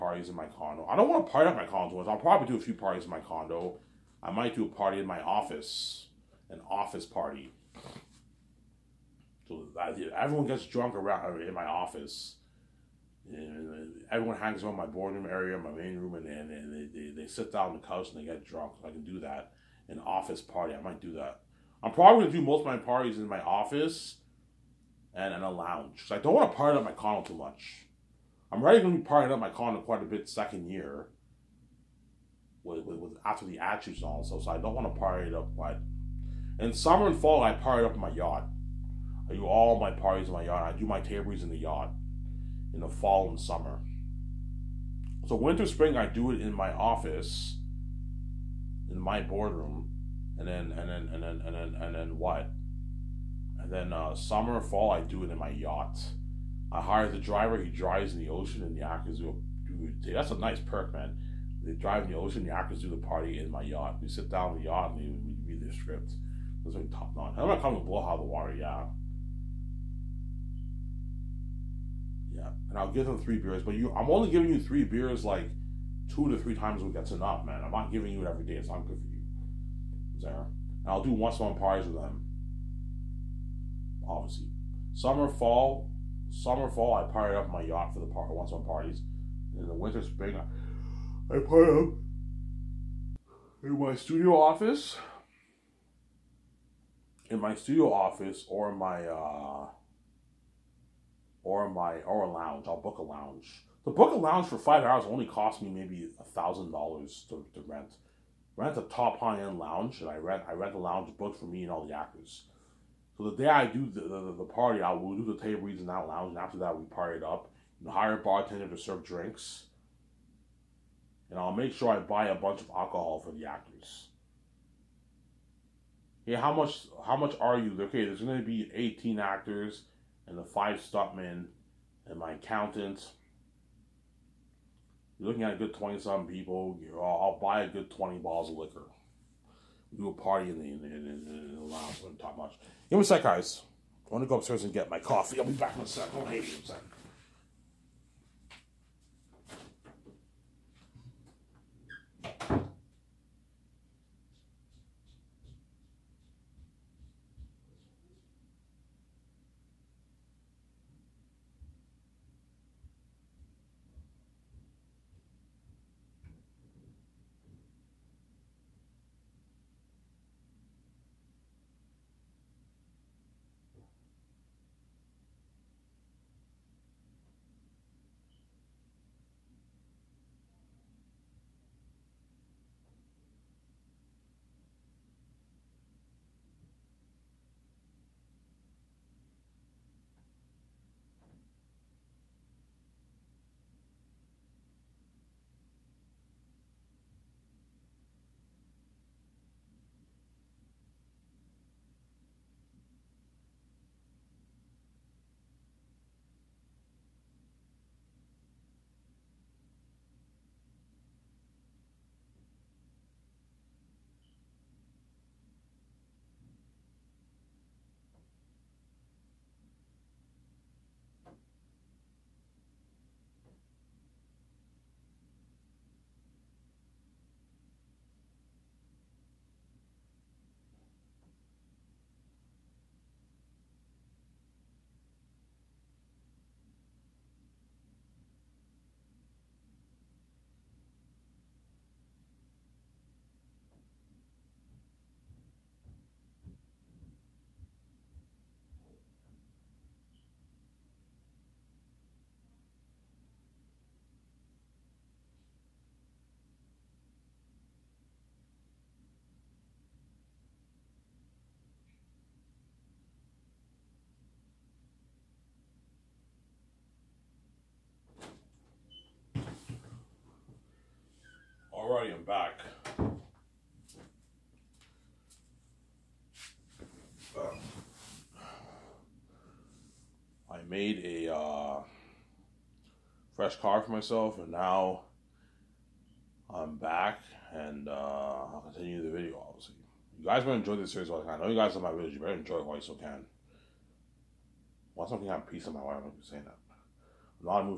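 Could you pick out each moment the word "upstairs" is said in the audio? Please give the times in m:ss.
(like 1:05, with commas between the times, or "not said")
2:24.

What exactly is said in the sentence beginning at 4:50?
You guys will enjoy this series while I can.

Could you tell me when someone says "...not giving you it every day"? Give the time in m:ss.
1:17.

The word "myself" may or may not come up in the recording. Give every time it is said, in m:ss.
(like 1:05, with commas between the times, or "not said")
4:43.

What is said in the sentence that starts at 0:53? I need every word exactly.
And then uh, summer, fall, I do it in my yacht.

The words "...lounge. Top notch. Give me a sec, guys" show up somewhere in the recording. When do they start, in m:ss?
2:21.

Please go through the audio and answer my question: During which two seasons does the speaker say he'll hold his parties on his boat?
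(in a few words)
Summer and fall.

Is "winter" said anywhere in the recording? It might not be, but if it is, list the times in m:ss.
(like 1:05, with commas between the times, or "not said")
0:45, 1:29.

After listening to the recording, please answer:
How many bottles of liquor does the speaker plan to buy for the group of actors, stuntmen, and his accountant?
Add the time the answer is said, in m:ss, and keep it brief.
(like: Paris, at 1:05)
20, at 2:17.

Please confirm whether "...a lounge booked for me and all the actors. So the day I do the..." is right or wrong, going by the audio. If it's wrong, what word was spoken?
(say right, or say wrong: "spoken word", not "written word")
right.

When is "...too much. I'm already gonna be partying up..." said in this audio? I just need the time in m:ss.
0:27.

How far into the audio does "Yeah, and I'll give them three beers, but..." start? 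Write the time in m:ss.
1:12.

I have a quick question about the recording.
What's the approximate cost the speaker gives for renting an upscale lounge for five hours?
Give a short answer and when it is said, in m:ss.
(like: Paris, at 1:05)
$1,000, at 1:46.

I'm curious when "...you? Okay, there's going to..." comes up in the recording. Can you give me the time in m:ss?
2:07.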